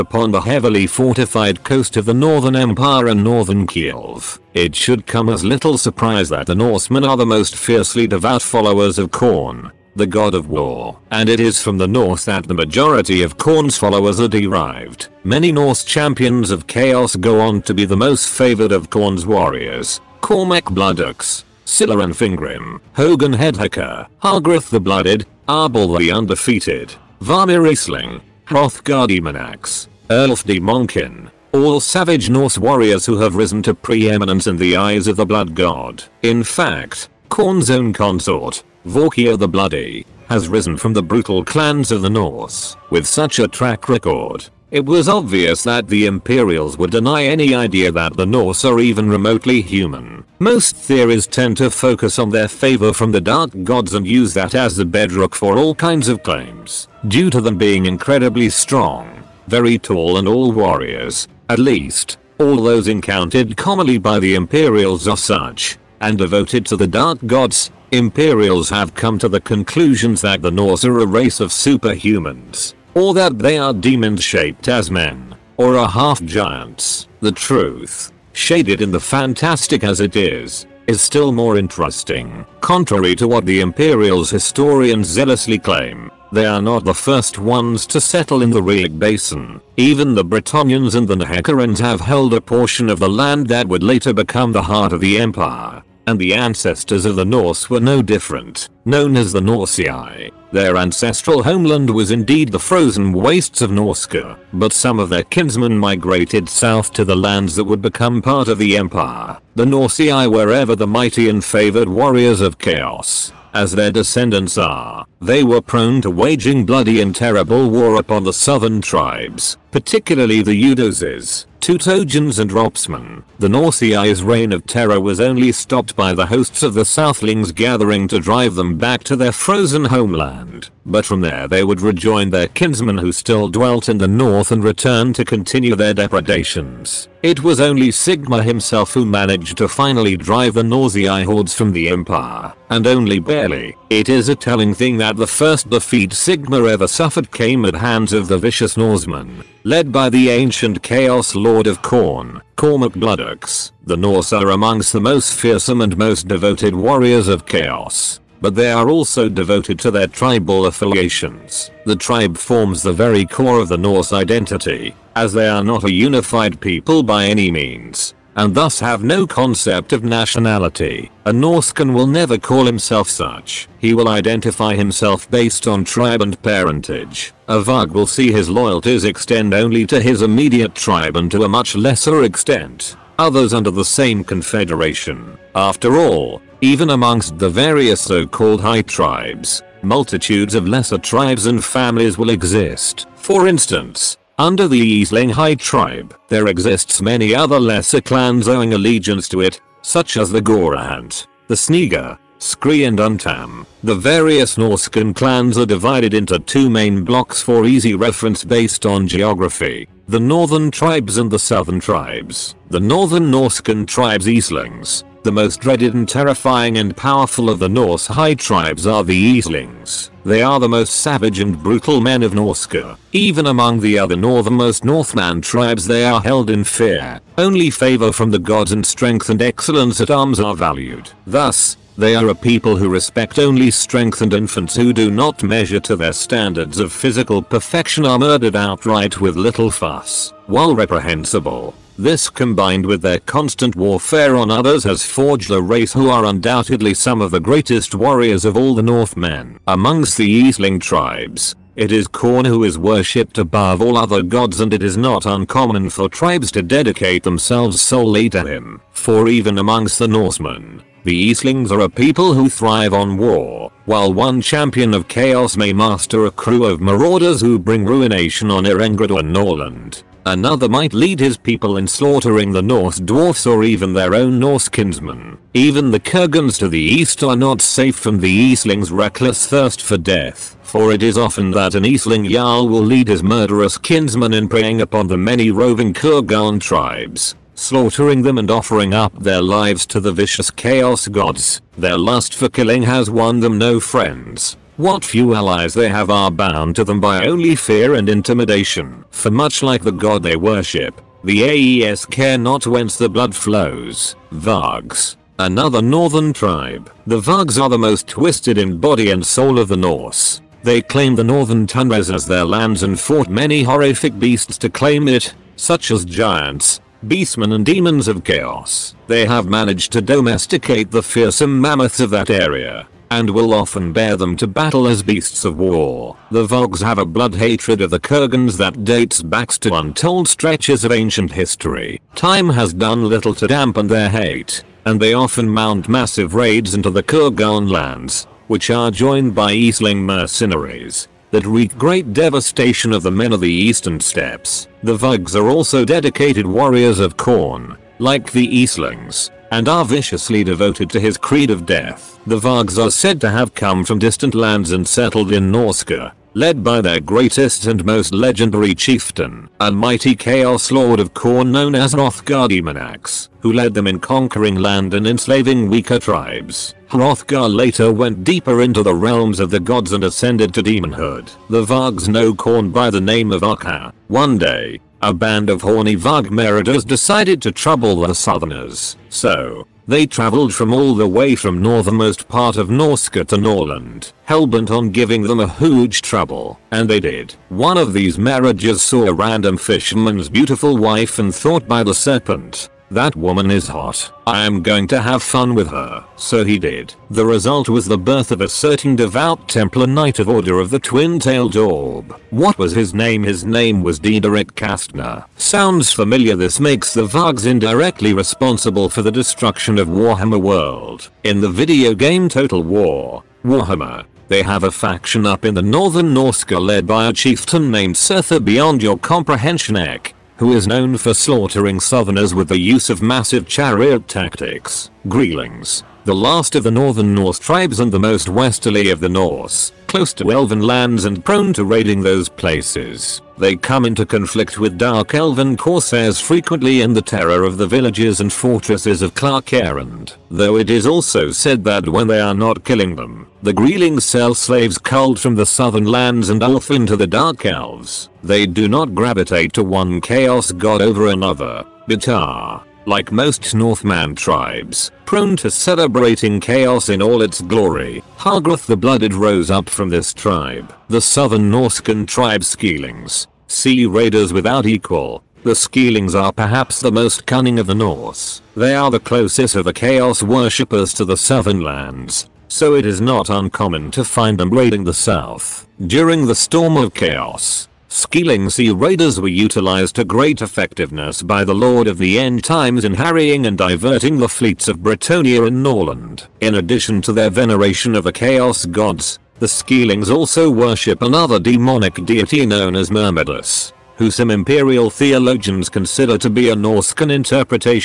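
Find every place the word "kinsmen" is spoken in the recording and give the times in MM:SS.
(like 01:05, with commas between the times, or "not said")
01:45, 02:12, 04:34, 04:43.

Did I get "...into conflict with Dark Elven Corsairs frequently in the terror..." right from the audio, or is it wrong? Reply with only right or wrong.
right.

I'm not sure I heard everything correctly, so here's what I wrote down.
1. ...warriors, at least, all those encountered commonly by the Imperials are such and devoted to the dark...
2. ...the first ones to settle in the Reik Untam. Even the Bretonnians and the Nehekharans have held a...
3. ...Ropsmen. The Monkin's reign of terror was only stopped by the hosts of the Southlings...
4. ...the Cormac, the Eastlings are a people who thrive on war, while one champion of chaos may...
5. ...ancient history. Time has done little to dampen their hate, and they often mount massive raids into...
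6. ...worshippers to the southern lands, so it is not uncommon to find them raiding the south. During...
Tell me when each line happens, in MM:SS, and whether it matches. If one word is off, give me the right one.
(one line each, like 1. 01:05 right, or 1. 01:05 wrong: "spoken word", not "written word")
1. 01:00 right
2. 01:26 wrong: "Basin", not "Untam"
3. 02:02 wrong: "Norseai", not "Monkin"
4. 04:19 wrong: "Norsemen", not "Cormac"
5. 05:30 right
6. 07:50 right.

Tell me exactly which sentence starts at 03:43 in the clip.
Even among the other northernmost Northman tribes they are held in fear.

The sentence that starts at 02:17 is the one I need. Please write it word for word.
It was only Sigmar himself who managed to finally drive the Norsei hordes from the empire, and only barely.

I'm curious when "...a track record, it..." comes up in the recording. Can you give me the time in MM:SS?
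00:43.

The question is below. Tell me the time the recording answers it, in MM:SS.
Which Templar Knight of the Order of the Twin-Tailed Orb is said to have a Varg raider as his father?
06:43.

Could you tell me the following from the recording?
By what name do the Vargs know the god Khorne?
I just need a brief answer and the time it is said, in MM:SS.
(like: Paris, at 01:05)
Akha, at 06:13.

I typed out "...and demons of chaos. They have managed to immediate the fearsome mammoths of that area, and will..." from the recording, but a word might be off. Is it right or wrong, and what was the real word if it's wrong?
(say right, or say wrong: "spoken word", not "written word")
wrong: "domesticate", not "immediate".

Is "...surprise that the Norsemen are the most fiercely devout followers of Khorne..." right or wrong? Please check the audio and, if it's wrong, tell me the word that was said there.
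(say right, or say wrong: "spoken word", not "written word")
right.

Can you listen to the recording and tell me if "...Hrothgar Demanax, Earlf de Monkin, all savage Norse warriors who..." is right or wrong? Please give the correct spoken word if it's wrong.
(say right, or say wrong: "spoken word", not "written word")
right.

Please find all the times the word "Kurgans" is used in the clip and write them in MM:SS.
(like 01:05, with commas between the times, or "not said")
04:35, 04:45, 05:27, 05:37.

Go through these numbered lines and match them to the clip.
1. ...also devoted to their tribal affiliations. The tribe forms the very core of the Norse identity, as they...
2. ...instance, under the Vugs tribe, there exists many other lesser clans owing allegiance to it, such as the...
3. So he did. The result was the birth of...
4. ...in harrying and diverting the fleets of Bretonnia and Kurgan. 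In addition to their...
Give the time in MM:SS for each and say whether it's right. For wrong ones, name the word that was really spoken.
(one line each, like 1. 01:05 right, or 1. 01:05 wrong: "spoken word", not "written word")
1. 02:38 right
2. 03:13 wrong: "High", not "Vugs"
3. 06:36 right
4. 08:02 wrong: "Nordland", not "Kurgan".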